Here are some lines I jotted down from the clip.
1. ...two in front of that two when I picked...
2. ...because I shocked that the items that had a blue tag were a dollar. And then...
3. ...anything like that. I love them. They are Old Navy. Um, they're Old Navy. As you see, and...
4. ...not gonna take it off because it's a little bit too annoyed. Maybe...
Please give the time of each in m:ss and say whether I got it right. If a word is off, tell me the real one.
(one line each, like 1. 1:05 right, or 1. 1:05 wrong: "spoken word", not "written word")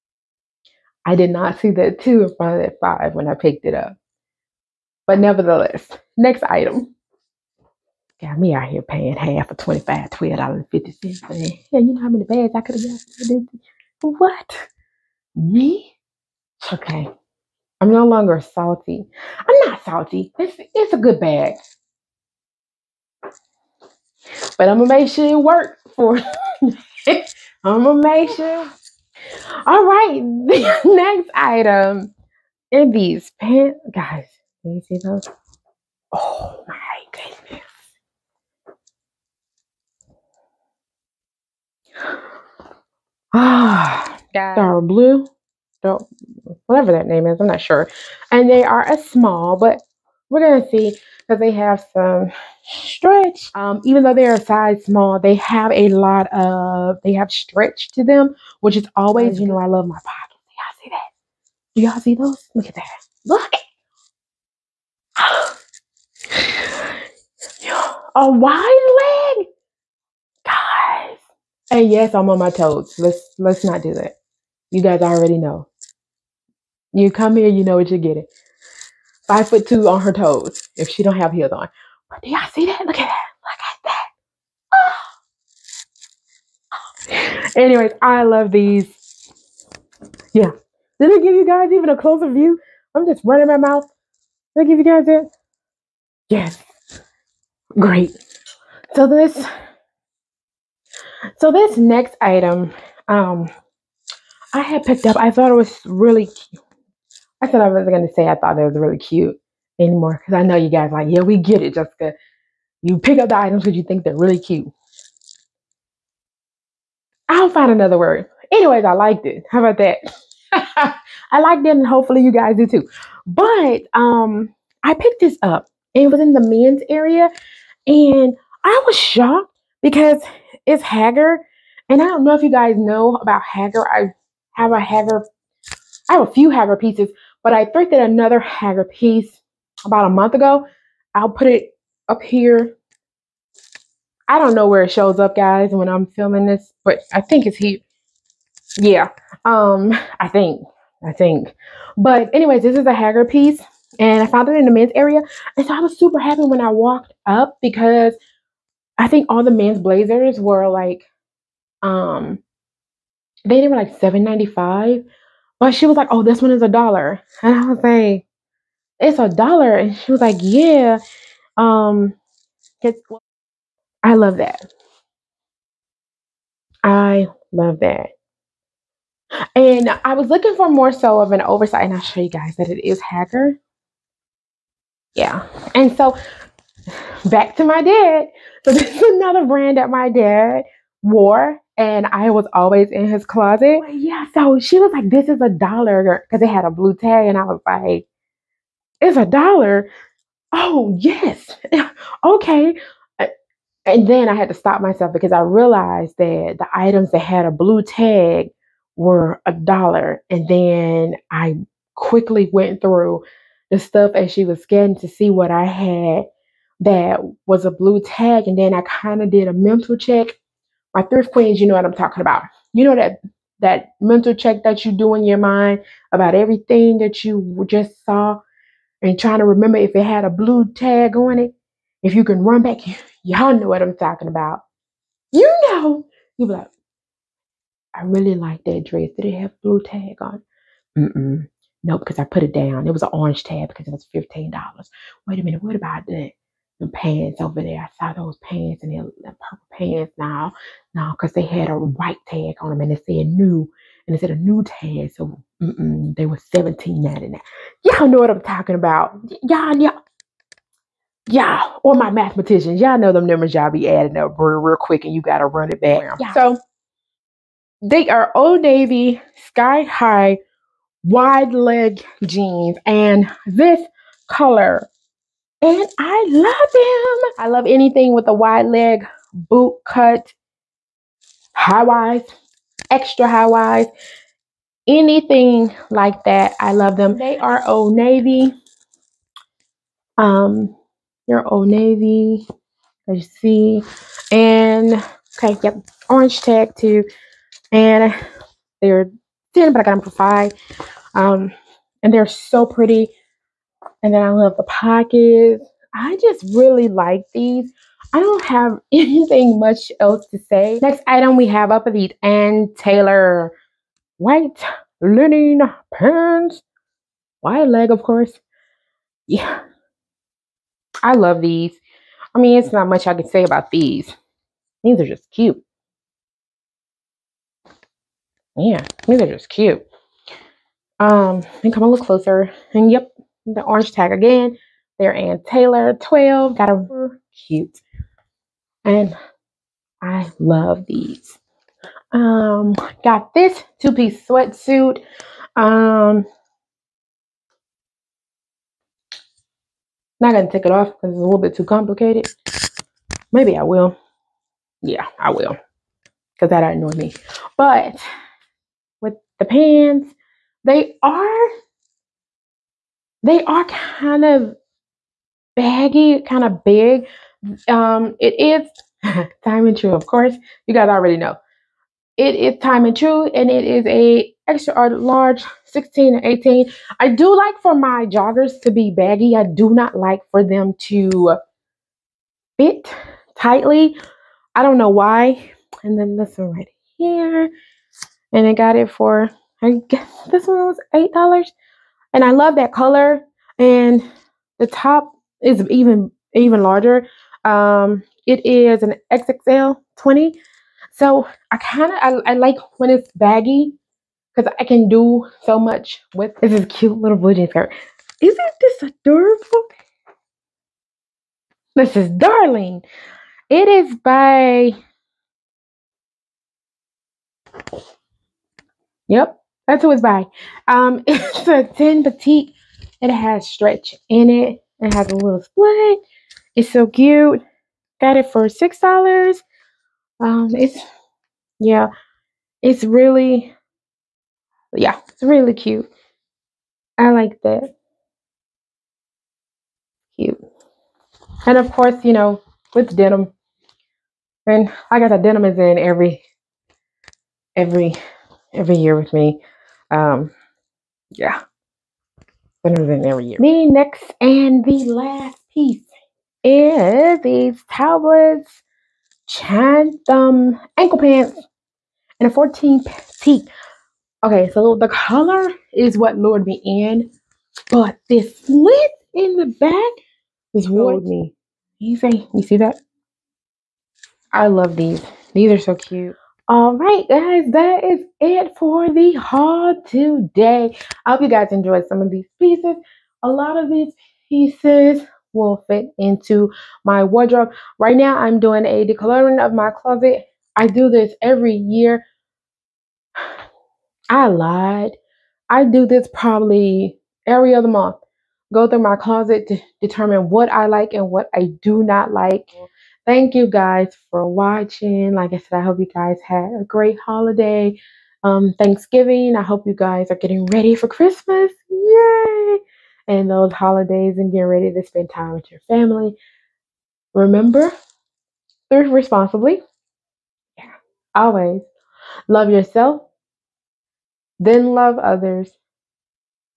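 1. 0:02 wrong: "five", not "two"
2. 3:25 wrong: "realized", not "shocked"
3. 4:44 right
4. 5:50 wrong: "complicated", not "annoyed".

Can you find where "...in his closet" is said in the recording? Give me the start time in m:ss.
3:12.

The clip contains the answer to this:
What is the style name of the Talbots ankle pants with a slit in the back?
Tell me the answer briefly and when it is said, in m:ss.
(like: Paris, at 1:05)
Chatham, at 7:39.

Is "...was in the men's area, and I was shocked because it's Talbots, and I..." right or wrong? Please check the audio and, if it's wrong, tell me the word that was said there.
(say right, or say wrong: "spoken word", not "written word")
wrong: "Haggar", not "Talbots".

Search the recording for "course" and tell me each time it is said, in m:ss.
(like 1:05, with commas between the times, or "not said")
5:18, 6:10, 7:21.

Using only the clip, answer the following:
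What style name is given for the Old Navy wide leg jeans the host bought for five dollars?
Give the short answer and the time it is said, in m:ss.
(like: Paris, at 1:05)
Sky high, at 4:29.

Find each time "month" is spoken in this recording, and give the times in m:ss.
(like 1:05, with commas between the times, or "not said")
2:20, 8:17.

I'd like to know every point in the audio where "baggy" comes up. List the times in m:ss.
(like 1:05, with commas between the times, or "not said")
6:05, 6:18, 6:43.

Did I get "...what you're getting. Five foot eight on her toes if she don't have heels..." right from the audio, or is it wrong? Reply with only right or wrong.
wrong.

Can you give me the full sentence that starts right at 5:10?
Next item we have, I these Ann Taylor white linen pants.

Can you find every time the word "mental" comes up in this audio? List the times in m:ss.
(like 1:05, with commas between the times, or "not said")
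3:39, 3:44.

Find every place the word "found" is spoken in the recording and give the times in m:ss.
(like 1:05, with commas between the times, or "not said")
2:34.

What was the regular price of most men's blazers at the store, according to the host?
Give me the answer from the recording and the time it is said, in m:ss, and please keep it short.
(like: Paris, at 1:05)
7.95, at 2:43.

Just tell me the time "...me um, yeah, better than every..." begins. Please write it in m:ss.
7:29.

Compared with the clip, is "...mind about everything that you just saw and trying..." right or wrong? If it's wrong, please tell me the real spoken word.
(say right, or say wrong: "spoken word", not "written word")
right.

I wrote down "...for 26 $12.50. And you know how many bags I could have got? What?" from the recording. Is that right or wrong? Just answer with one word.
wrong.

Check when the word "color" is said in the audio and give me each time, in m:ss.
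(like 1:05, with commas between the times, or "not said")
4:34, 6:32, 7:44.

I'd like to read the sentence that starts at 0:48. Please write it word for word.
And they are a small, but we're gonna see because they have some stretch.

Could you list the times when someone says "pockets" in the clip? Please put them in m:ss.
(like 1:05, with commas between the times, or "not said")
1:00, 5:04.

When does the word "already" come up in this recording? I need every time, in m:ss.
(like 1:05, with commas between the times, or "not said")
1:15, 6:10.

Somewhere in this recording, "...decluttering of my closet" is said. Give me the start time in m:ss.
8:08.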